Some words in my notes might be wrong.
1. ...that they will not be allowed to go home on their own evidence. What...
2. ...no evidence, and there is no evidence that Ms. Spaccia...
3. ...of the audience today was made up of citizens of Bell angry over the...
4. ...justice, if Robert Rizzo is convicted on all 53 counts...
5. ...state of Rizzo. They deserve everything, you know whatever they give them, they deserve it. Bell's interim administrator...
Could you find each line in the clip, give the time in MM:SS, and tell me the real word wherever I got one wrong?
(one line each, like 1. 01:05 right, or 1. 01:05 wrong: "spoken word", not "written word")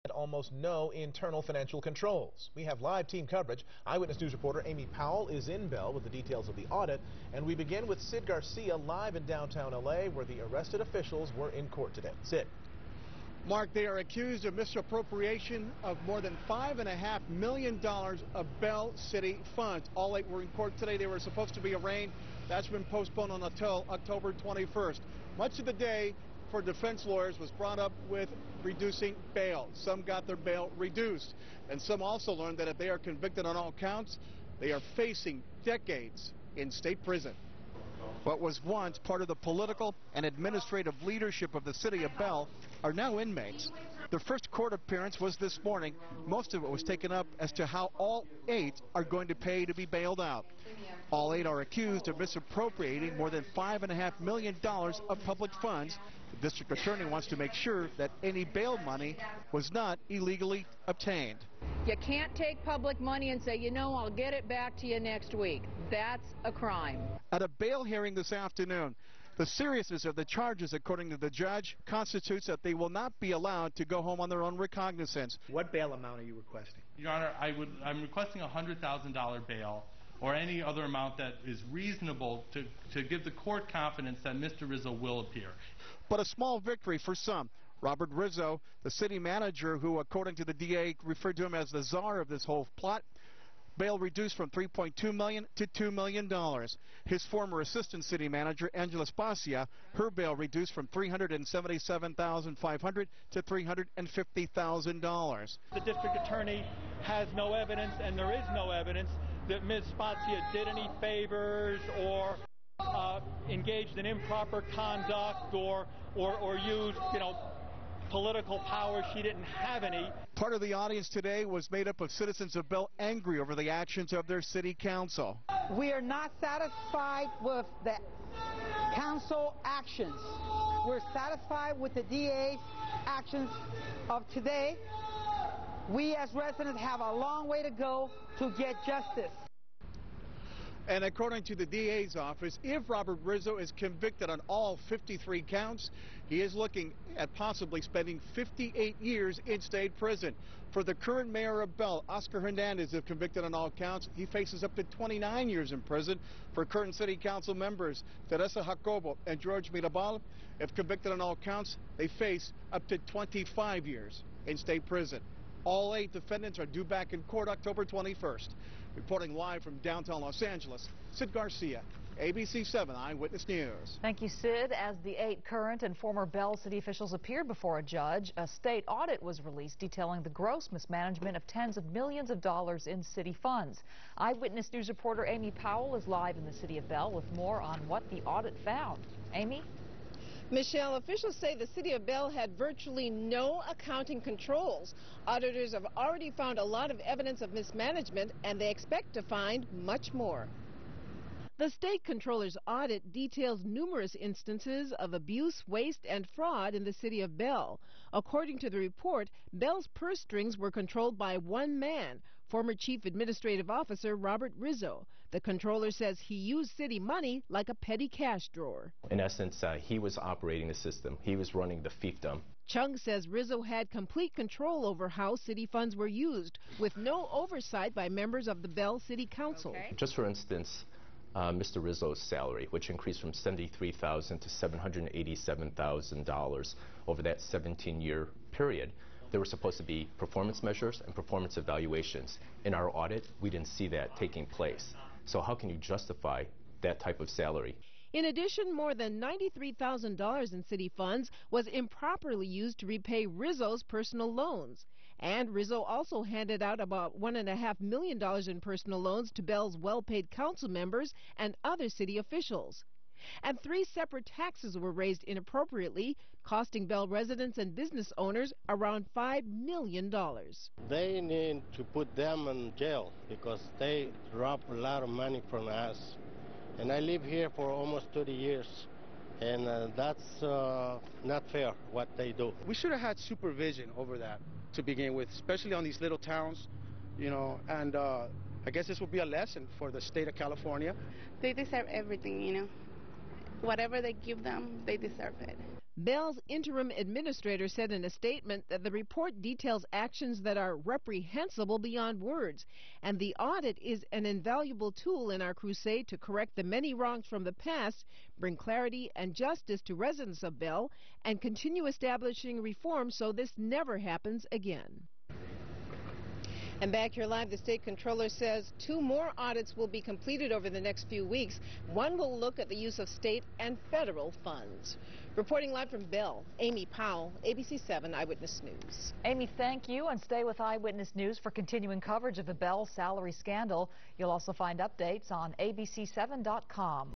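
1. 01:12 wrong: "recognizance", not "evidence"
2. 01:47 right
3. 02:00 right
4. 02:22 wrong: "office", not "justice"
5. 04:49 wrong: "California", not "Rizzo".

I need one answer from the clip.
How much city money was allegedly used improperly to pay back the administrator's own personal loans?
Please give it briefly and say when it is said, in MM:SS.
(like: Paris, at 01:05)
$93,000, at 04:09.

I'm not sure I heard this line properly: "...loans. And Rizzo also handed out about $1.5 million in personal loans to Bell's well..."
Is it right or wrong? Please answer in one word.
right.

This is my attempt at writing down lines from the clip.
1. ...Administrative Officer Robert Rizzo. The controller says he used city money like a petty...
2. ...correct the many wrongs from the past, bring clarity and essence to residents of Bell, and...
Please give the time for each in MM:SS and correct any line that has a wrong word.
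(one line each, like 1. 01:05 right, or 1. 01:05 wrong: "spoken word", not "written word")
1. 03:33 right
2. 05:06 wrong: "justice", not "essence".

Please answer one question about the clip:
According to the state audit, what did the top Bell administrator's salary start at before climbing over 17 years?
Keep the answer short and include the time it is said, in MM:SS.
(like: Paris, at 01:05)
$73,000, at 03:53.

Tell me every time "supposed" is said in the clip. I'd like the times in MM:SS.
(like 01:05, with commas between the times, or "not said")
00:21, 03:59.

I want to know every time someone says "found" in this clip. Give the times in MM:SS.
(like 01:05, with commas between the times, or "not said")
03:08, 03:16.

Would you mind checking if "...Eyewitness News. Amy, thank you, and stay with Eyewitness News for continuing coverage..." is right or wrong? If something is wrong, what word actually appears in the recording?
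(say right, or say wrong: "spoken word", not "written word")
right.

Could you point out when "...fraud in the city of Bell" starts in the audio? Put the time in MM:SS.
03:26.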